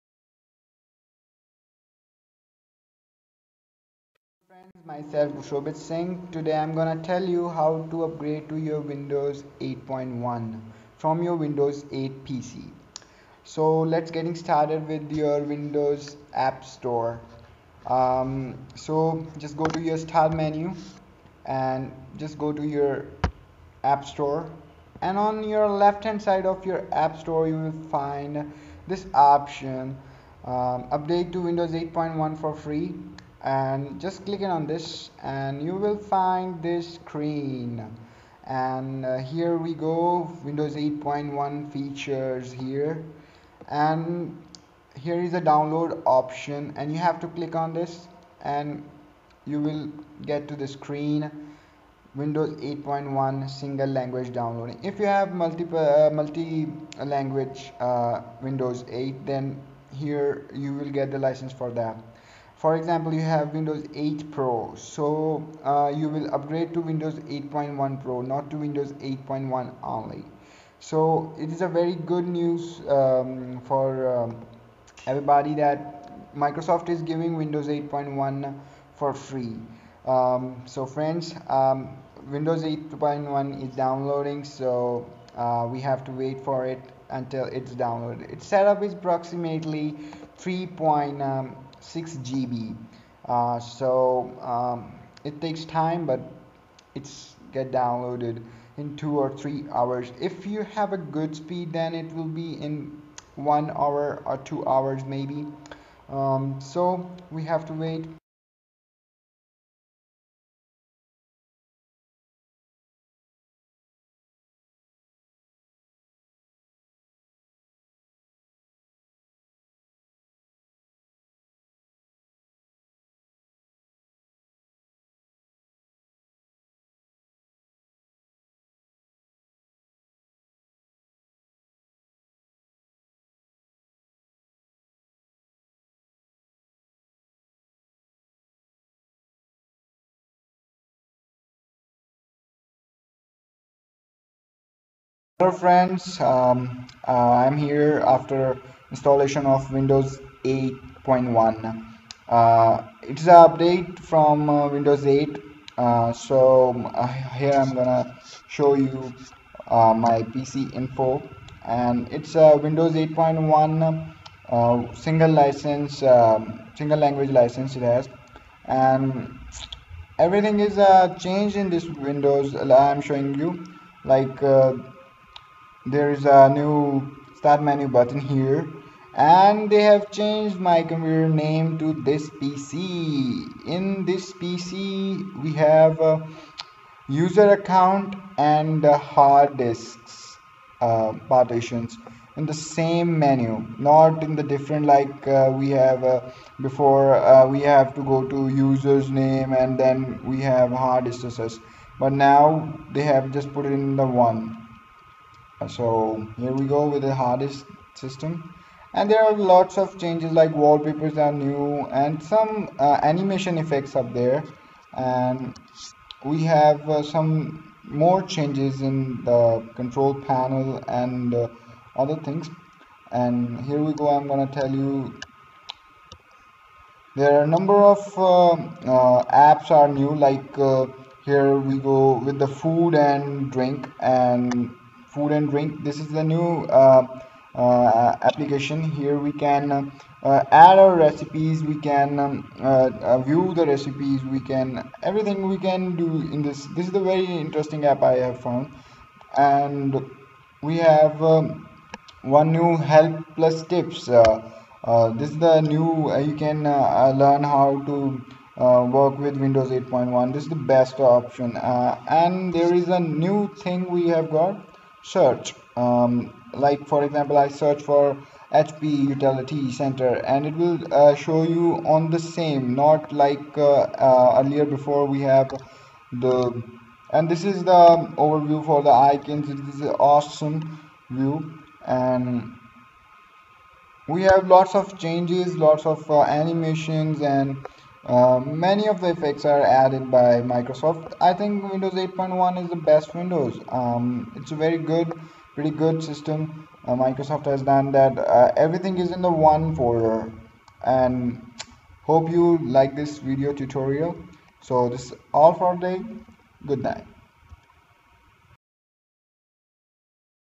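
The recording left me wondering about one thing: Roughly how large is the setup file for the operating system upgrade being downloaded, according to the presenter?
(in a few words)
3.6 GB.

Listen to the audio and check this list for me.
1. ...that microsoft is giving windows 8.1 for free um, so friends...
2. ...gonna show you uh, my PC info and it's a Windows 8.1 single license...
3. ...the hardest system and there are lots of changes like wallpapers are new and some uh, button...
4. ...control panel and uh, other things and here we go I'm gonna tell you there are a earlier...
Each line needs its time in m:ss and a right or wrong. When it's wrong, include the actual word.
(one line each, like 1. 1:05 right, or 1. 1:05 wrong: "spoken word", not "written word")
1. 1:15 right
2. 2:37 right
3. 3:27 wrong: "animation", not "button"
4. 3:39 wrong: "number", not "earlier".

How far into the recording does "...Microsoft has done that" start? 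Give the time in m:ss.
4:56.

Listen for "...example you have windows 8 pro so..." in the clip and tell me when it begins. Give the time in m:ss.
1:02.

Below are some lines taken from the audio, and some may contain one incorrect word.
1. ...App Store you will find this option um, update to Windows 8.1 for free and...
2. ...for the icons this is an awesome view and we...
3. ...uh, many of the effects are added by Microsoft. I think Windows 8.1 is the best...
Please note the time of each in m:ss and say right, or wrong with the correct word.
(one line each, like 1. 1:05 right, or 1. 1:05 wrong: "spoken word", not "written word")
1. 0:26 right
2. 4:38 right
3. 4:48 right.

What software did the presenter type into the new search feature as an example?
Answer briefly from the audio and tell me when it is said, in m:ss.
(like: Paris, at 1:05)
HP utility center, at 4:28.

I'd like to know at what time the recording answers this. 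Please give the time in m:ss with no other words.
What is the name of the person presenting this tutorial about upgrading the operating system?
0:05.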